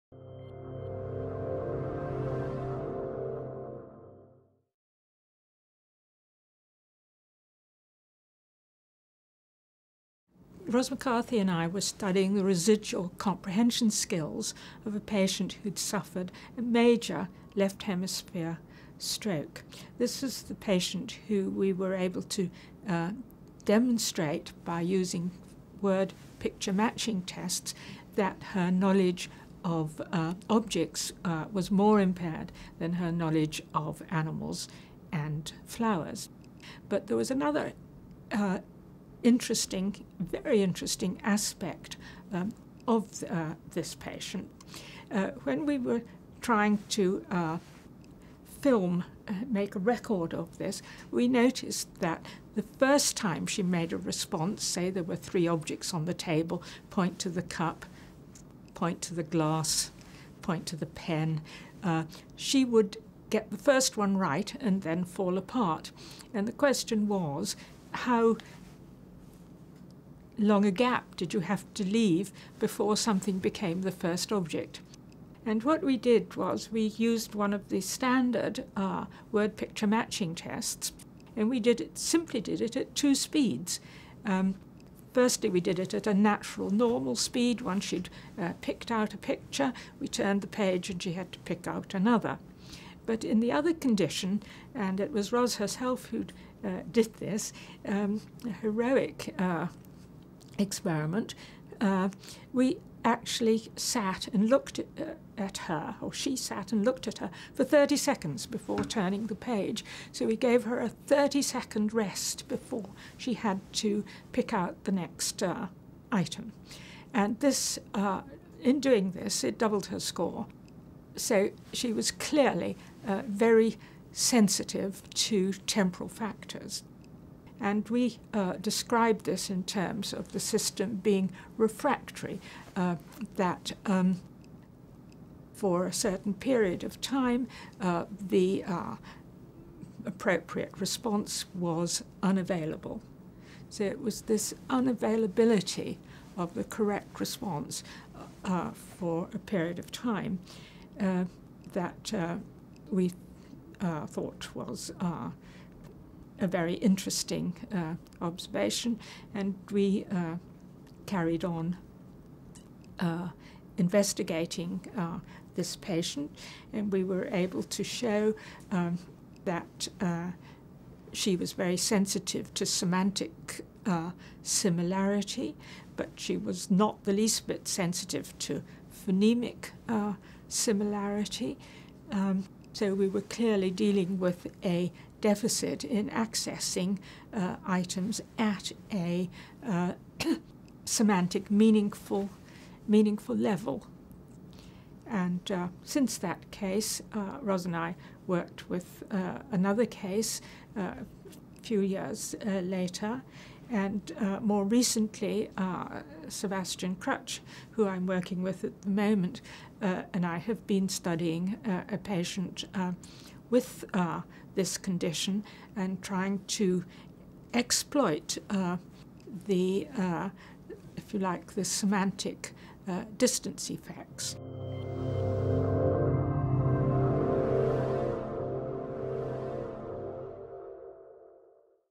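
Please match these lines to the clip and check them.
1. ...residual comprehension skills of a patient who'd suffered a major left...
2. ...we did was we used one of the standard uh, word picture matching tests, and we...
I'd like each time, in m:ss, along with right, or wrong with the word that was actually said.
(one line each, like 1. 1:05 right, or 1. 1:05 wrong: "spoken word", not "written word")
1. 0:12 right
2. 1:15 right.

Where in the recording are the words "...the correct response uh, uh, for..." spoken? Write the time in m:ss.
2:26.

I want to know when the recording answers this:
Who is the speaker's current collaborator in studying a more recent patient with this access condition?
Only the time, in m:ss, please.
3:26.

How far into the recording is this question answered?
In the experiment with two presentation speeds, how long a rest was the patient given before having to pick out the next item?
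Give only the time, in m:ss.
1:50.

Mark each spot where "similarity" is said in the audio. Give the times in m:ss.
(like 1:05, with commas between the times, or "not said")
2:54, 3:00.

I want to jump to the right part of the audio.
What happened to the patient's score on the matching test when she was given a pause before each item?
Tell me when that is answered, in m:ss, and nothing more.
1:59.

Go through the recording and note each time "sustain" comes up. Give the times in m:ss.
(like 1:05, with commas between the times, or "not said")
not said.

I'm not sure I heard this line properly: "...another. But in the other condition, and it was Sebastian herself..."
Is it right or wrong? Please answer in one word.
wrong.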